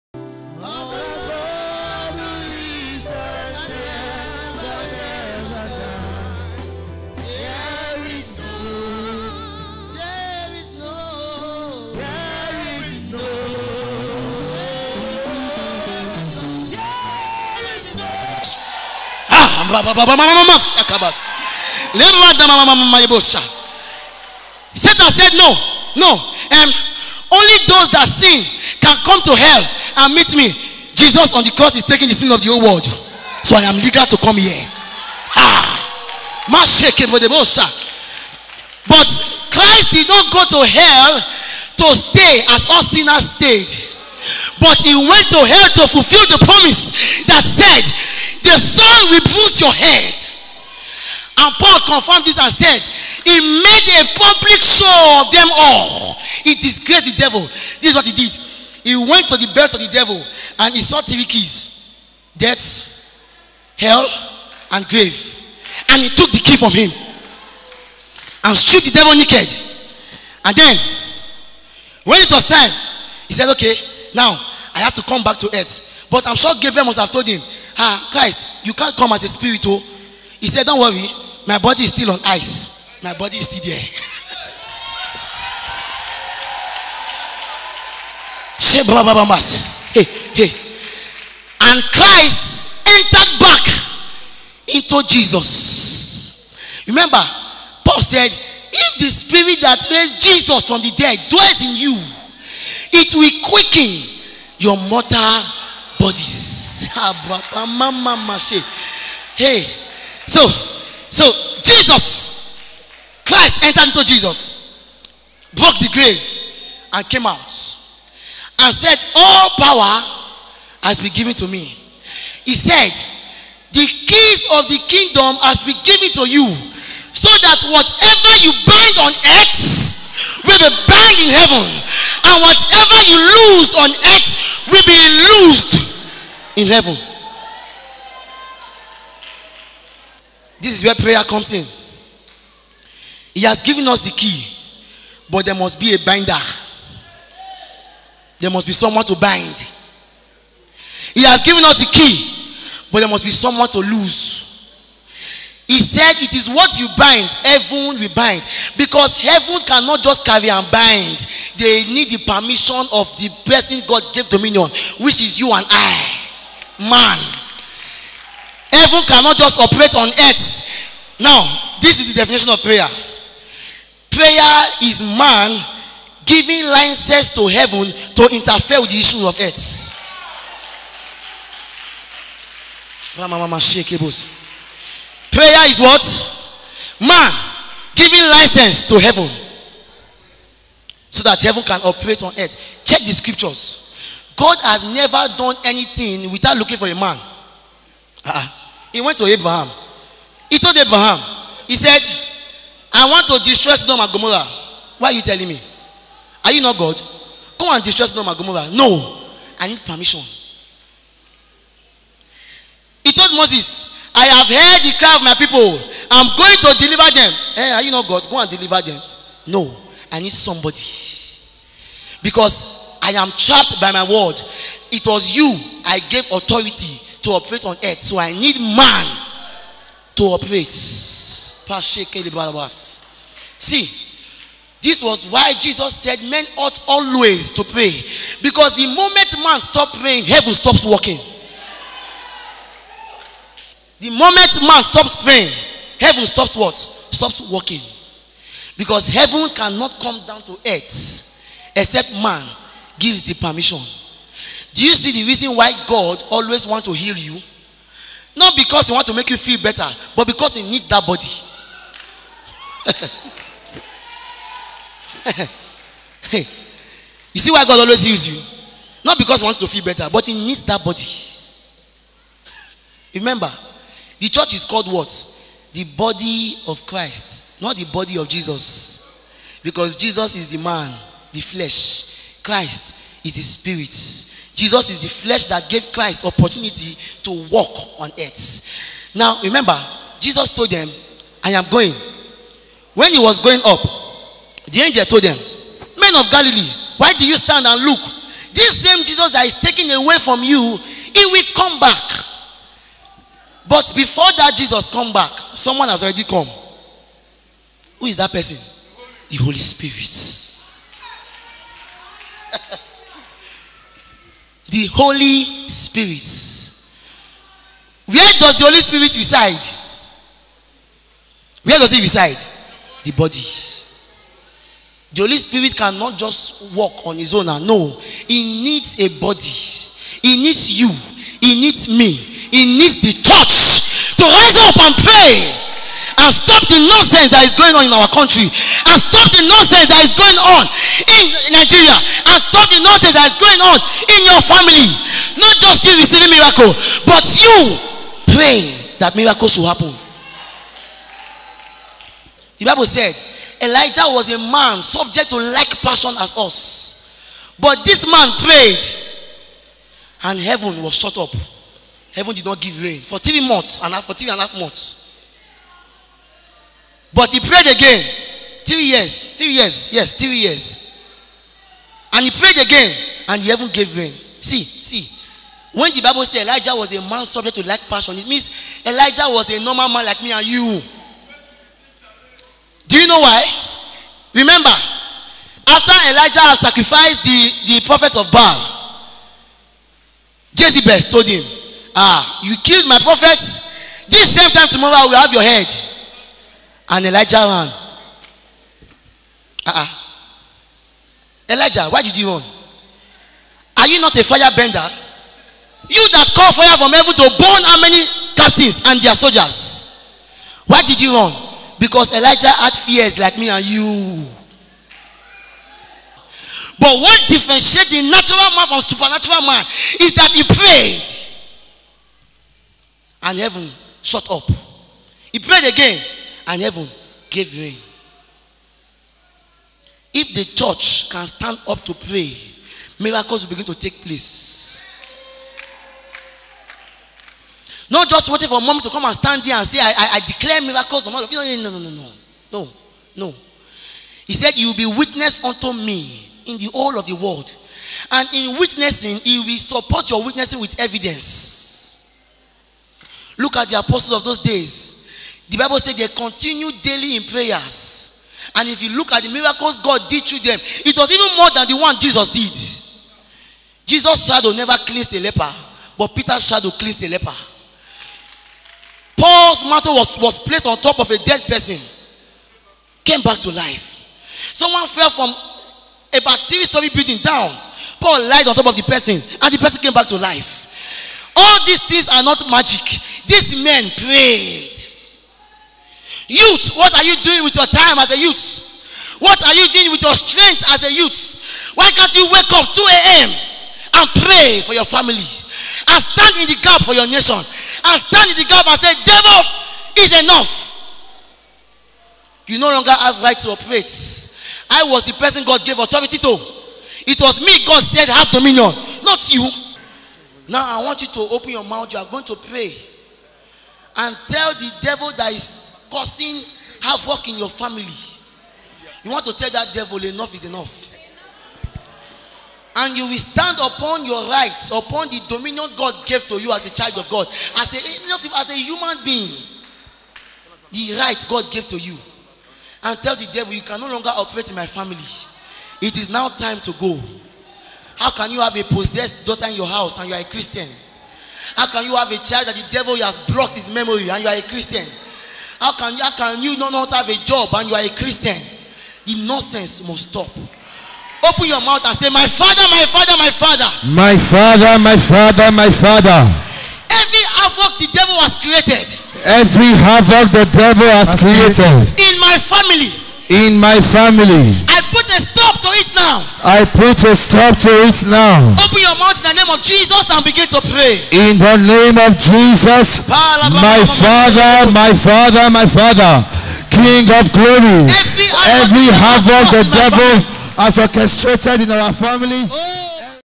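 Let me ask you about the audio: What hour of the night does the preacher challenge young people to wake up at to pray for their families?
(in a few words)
2 a.m.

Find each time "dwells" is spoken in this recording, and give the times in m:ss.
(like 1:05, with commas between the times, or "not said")
1:41.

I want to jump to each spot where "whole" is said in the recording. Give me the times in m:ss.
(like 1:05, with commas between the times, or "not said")
0:32, 7:26.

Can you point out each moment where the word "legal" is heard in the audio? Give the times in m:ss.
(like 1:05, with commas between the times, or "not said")
0:33.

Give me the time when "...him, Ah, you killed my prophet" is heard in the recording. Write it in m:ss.
6:31.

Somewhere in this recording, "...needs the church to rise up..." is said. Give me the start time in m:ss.
5:32.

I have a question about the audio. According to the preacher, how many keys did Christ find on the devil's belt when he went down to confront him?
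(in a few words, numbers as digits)
3.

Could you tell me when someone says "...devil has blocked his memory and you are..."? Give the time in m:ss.
9:02.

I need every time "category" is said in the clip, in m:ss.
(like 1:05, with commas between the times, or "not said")
not said.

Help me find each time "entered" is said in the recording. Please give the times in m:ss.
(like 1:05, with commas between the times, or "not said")
1:32, 1:53.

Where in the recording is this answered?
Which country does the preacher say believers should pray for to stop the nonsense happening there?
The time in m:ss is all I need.
5:41.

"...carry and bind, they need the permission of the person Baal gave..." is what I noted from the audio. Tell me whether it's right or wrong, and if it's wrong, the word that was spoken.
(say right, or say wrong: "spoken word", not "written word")
wrong: "God", not "Baal".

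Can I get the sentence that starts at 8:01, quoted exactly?
All these things are not magic.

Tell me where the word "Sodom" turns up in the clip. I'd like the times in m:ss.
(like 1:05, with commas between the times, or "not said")
3:23, 3:28.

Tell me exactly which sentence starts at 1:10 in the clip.
And then, when it was time, he said, Okay, now I have to come back to earth.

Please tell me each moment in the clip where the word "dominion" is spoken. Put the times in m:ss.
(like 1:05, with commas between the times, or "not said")
2:44, 8:28, 8:45.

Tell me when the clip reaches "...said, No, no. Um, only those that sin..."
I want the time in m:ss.
0:25.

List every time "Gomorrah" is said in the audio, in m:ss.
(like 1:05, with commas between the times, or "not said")
3:24, 3:28.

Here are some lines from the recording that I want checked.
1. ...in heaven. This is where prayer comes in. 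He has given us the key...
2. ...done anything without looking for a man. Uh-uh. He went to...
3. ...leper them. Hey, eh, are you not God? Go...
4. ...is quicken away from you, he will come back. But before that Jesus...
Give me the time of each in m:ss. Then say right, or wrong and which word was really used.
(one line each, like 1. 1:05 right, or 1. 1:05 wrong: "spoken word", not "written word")
1. 2:16 right
2. 3:15 right
3. 3:36 wrong: "deliver", not "leper"
4. 4:59 wrong: "taken", not "quicken".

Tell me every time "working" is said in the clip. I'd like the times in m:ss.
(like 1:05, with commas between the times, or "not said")
4:00, 4:07.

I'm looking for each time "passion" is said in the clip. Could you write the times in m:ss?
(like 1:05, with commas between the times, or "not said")
5:55, 6:17.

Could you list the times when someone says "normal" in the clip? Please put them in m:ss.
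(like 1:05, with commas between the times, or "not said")
6:19.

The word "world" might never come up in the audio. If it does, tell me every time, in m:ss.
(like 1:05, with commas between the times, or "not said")
0:32, 7:27.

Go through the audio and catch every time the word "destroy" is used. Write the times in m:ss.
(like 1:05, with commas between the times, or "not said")
3:23, 3:27.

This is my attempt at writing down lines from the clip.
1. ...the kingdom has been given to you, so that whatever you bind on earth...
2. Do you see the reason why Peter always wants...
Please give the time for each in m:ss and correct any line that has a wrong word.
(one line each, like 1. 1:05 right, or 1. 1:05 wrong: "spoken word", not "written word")
1. 2:04 right
2. 4:14 wrong: "God", not "Peter".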